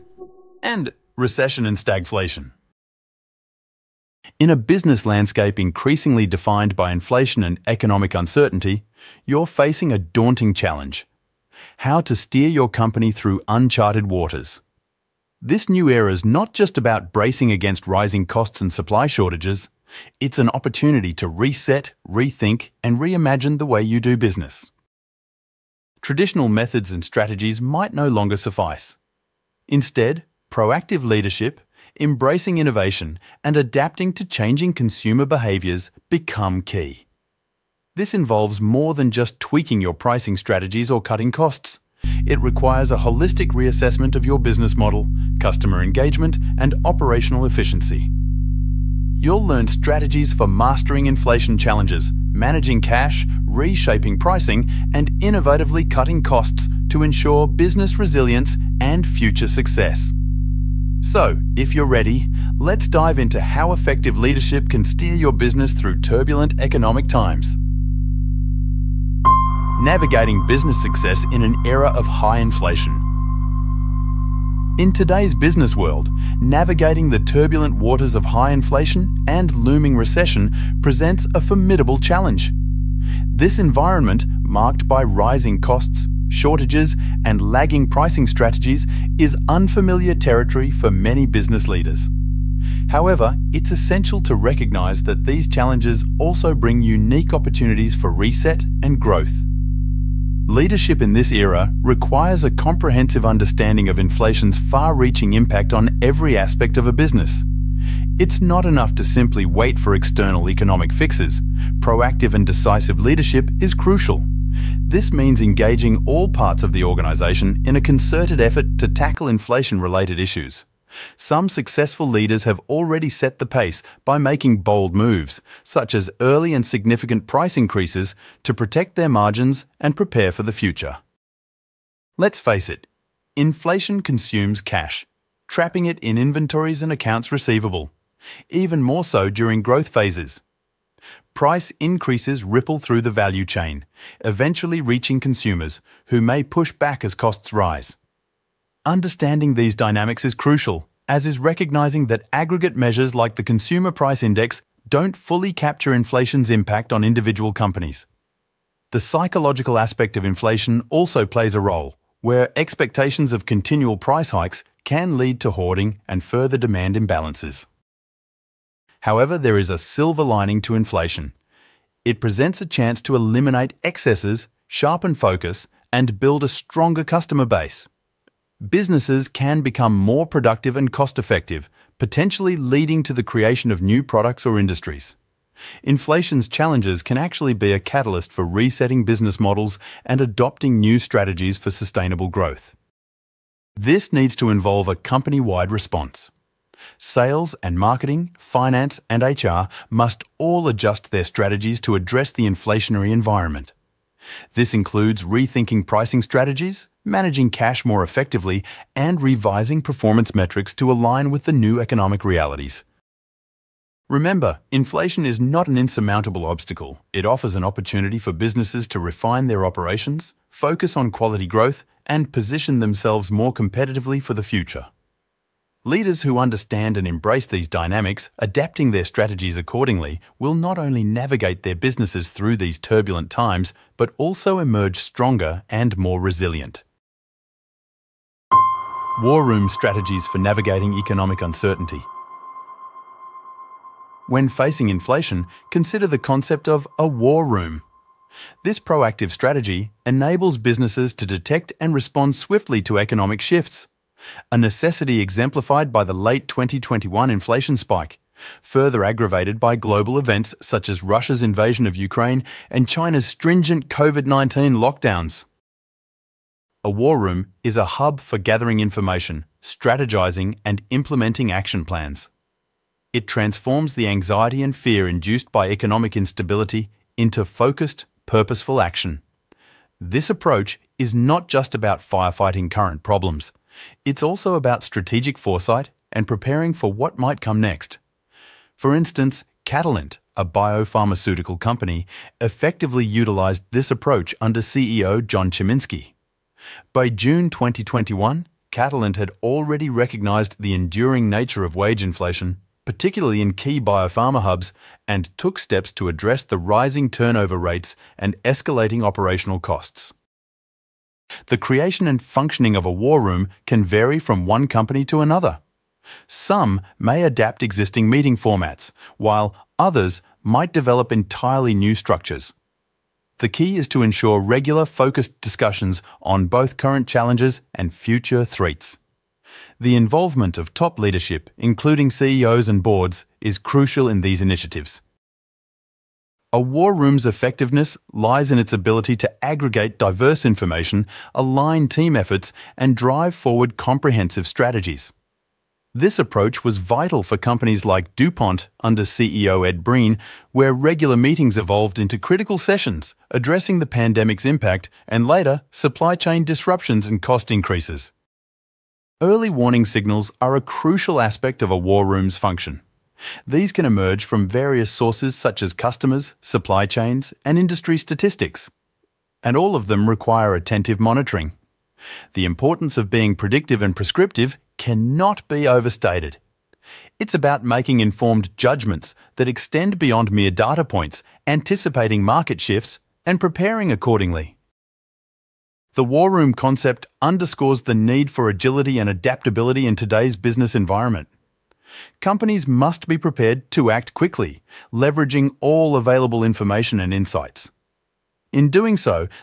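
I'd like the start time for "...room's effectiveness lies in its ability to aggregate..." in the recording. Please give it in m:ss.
5:36.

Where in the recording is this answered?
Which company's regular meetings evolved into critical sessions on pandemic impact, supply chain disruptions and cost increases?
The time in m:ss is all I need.
5:48.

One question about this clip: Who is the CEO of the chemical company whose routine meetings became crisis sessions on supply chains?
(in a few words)
Ed Breen.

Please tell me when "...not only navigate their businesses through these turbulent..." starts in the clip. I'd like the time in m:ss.
3:50.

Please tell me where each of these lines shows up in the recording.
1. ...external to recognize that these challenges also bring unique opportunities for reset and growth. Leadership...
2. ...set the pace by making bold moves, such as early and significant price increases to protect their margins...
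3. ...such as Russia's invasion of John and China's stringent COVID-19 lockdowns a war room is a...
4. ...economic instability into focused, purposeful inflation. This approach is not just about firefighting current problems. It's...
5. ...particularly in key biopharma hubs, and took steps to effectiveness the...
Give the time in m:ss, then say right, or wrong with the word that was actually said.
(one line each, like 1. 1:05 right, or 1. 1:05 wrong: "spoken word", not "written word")
1. 1:33 wrong: "essential", not "external"
2. 2:03 right
3. 4:20 wrong: "Ukraine", not "John"
4. 4:35 wrong: "action", not "inflation"
5. 5:02 wrong: "address", not "effectiveness".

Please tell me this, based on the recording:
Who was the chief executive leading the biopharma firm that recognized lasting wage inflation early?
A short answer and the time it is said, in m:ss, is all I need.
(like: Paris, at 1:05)
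John Chiminski, at 4:55.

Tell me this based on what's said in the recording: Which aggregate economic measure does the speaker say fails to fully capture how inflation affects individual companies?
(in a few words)
Consumer Price Index.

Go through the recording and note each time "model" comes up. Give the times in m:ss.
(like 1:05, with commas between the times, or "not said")
0:44, 3:09.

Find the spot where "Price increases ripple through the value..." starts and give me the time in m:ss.
2:21.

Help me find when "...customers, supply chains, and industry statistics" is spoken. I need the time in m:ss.
6:05.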